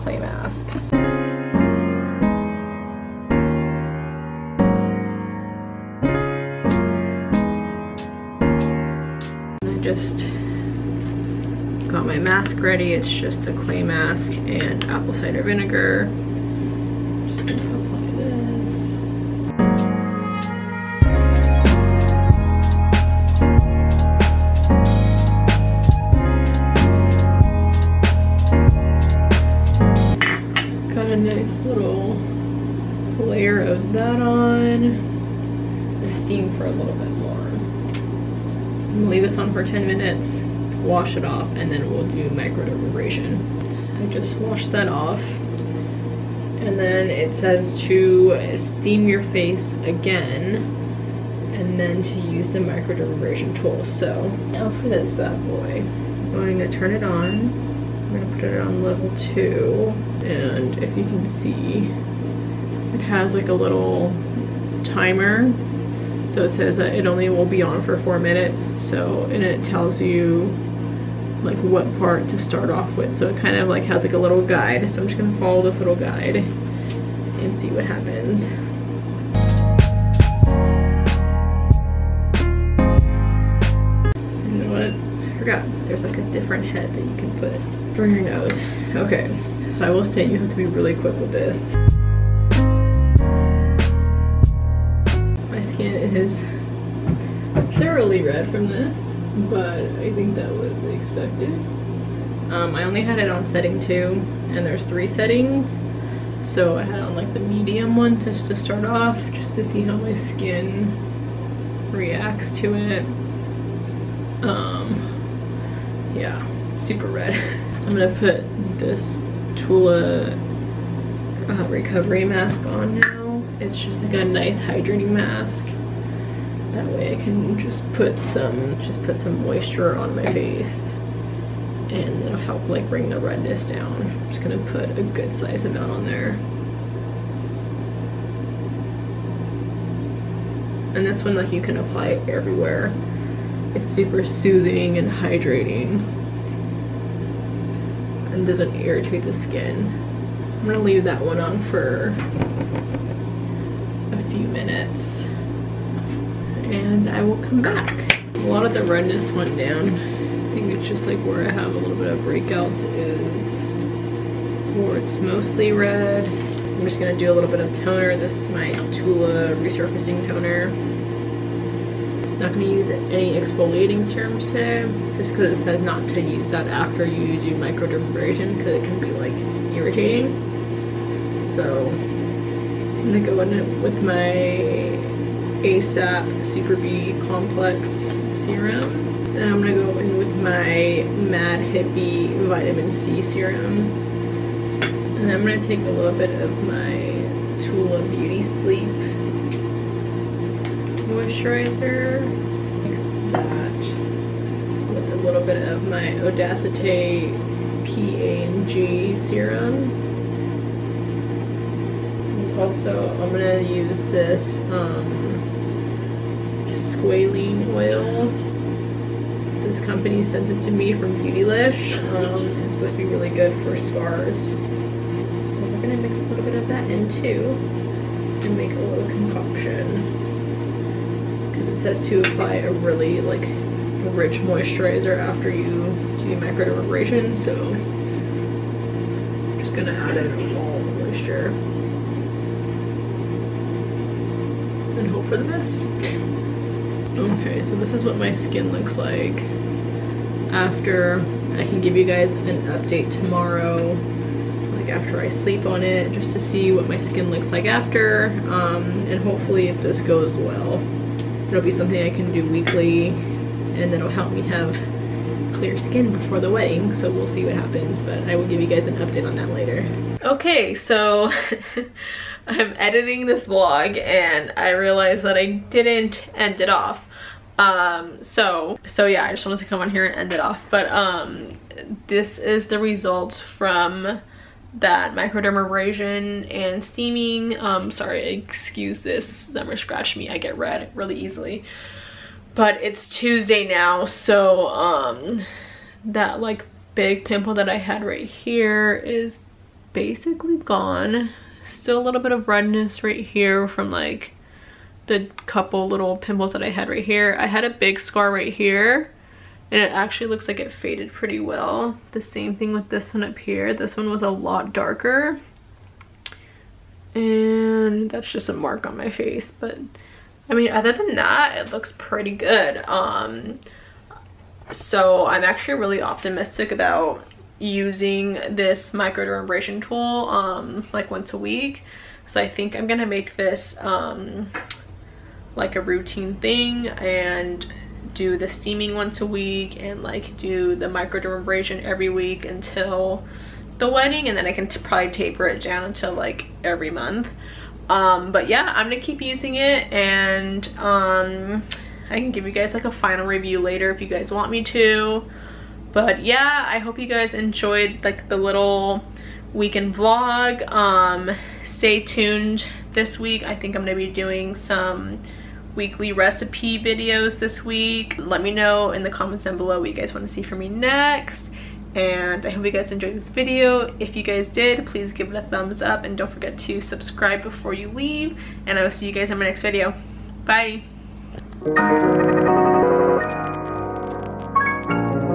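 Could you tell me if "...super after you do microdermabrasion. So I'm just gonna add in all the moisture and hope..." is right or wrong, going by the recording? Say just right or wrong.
wrong.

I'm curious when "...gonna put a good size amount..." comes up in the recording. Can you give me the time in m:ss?
2:14.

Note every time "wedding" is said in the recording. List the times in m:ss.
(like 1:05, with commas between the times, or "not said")
4:26, 5:43.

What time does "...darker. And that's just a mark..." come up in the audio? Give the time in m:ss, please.
5:14.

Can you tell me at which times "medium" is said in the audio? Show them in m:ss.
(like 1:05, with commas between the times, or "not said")
1:47.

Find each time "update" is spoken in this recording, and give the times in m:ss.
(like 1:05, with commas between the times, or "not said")
4:12, 4:28.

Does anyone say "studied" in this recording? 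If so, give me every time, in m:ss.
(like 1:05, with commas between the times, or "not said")
not said.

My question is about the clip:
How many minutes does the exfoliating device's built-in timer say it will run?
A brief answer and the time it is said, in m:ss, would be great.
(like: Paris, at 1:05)
4, at 1:08.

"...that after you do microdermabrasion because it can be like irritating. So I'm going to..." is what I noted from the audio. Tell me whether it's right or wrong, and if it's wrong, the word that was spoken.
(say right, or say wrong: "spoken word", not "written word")
right.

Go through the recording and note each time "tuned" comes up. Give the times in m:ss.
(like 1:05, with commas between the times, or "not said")
6:01.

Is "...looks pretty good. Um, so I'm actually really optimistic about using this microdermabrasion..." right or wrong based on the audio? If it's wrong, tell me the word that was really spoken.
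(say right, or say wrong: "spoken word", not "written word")
right.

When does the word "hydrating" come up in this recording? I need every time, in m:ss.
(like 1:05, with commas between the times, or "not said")
2:04, 2:25.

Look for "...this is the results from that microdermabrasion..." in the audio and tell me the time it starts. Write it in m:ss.
4:42.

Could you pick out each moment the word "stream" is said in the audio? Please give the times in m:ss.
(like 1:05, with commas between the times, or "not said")
not said.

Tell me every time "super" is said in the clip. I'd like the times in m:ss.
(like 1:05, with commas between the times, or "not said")
1:56, 2:23, 3:06.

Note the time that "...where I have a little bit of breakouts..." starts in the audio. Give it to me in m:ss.
2:41.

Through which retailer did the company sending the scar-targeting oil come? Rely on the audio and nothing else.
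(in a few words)
Beautylish.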